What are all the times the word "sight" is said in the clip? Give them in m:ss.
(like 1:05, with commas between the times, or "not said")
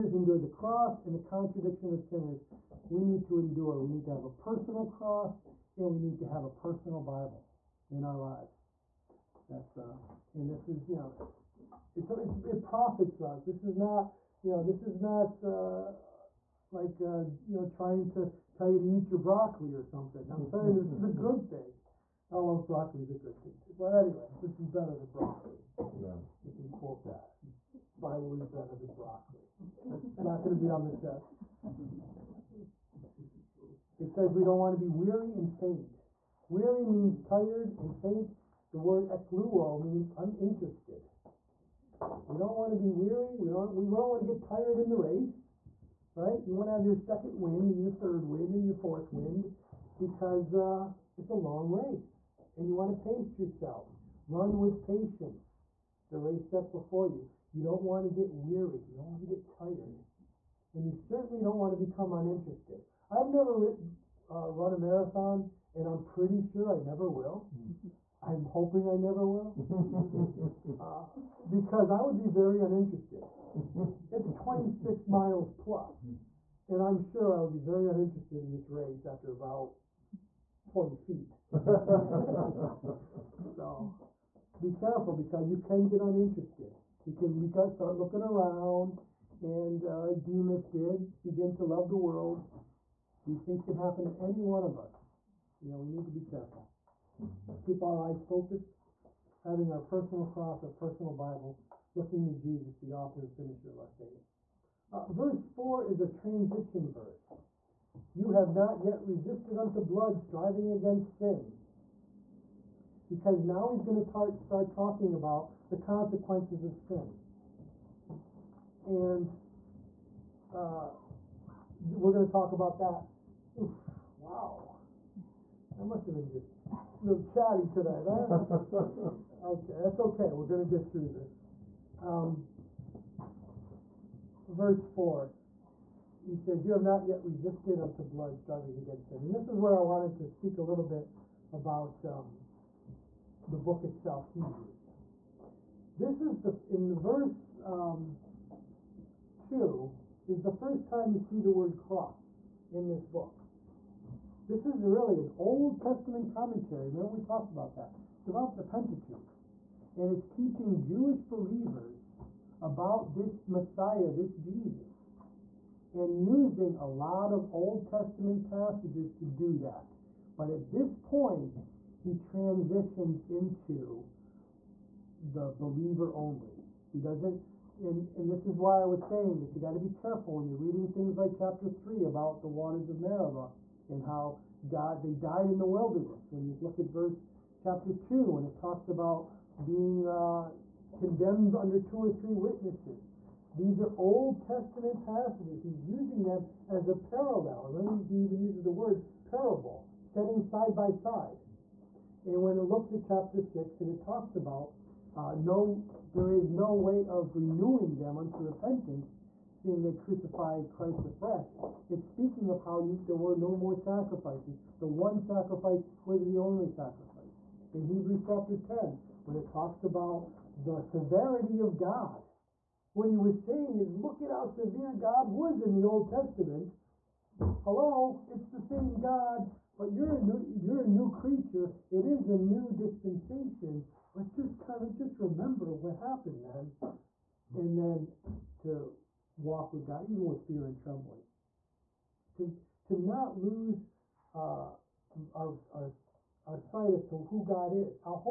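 4:06.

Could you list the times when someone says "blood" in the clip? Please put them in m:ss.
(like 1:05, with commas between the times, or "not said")
1:49, 2:18.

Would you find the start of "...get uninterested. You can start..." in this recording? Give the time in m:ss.
1:25.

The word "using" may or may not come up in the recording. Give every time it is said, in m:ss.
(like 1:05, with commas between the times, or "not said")
2:46, 3:15.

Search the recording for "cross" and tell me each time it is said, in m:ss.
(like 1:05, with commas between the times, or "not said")
0:00, 0:04, 1:40, 2:31.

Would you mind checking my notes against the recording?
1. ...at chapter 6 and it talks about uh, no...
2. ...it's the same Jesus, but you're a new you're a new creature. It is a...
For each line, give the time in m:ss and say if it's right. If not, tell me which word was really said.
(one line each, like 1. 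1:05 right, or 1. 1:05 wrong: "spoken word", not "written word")
1. 3:22 right
2. 3:48 wrong: "God", not "Jesus".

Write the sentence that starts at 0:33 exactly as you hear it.
It says we don't want to be weary and faint.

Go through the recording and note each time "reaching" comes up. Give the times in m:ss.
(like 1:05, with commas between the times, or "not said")
not said.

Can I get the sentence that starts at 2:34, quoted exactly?
This is really an Old Testament commentary.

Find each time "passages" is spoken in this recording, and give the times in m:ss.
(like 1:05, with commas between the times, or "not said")
2:48, 3:15.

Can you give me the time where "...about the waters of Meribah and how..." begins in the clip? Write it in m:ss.
3:02.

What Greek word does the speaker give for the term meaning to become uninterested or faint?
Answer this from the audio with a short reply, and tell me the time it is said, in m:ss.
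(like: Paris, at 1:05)
Ekluo, at 0:39.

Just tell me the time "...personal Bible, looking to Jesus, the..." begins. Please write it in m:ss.
1:40.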